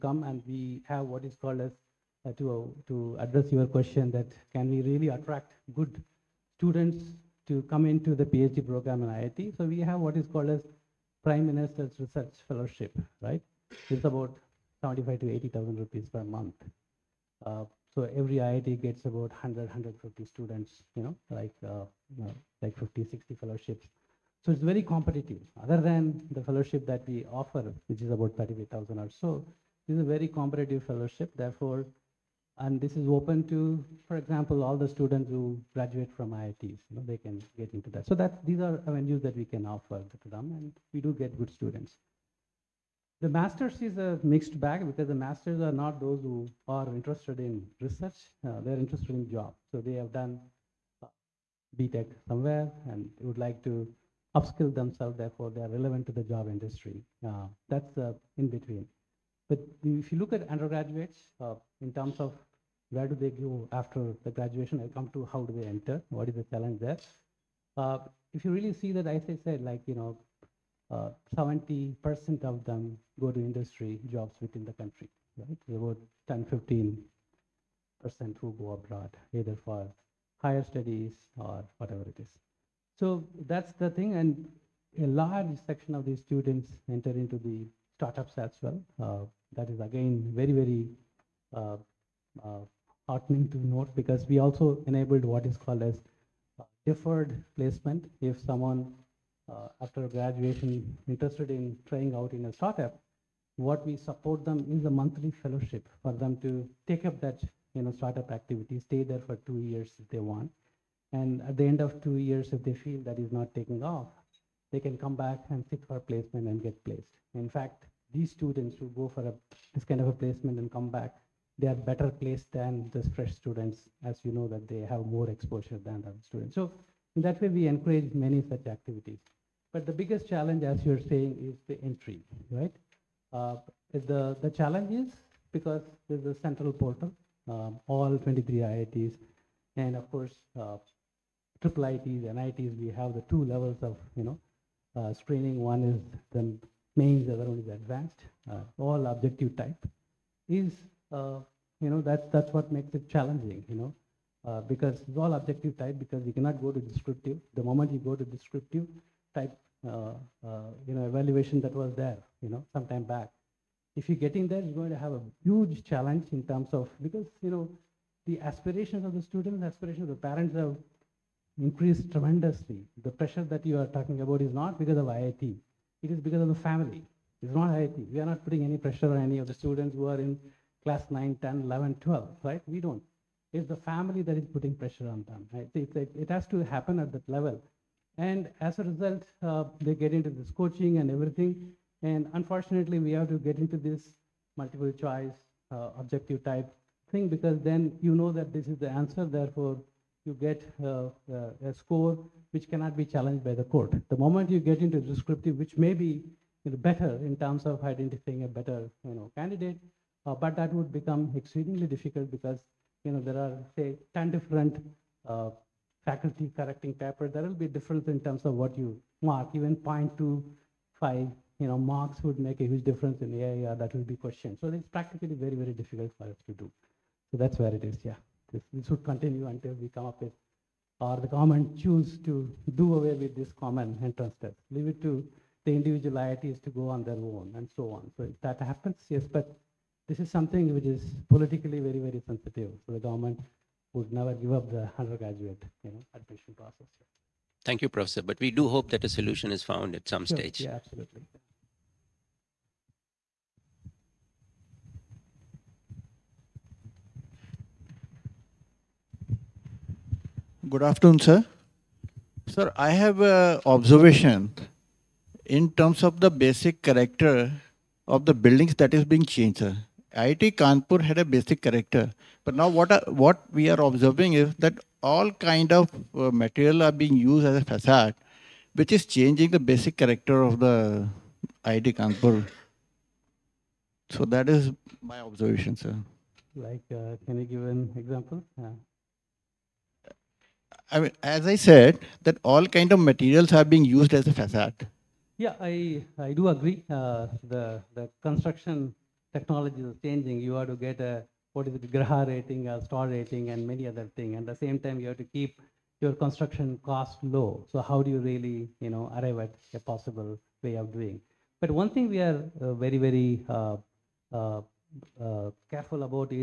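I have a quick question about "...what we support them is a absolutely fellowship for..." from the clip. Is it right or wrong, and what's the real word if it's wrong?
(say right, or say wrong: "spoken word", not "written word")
wrong: "monthly", not "absolutely".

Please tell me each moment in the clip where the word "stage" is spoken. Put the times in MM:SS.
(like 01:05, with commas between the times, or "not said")
04:10.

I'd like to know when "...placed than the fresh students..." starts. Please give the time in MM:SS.
02:02.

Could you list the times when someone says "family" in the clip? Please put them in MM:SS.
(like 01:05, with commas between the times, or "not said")
02:56, 03:03.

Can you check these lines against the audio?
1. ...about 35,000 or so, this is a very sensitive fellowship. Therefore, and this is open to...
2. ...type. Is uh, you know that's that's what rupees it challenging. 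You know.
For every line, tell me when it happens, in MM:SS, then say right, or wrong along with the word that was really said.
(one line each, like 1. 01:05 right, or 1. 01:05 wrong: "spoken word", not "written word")
1. 00:28 wrong: "competitive", not "sensitive"
2. 02:29 wrong: "makes", not "rupees".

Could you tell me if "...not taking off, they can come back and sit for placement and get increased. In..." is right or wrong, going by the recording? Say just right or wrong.
wrong.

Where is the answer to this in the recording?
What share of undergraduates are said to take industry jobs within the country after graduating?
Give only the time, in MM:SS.
01:11.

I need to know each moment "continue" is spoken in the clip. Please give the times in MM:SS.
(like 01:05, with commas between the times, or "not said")
03:49.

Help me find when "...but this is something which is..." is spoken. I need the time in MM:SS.
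03:59.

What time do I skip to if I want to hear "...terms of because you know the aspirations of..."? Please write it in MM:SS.
02:46.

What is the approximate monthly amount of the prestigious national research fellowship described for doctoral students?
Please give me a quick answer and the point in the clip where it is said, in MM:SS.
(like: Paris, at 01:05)
75 to 80,000 rupees, at 00:14.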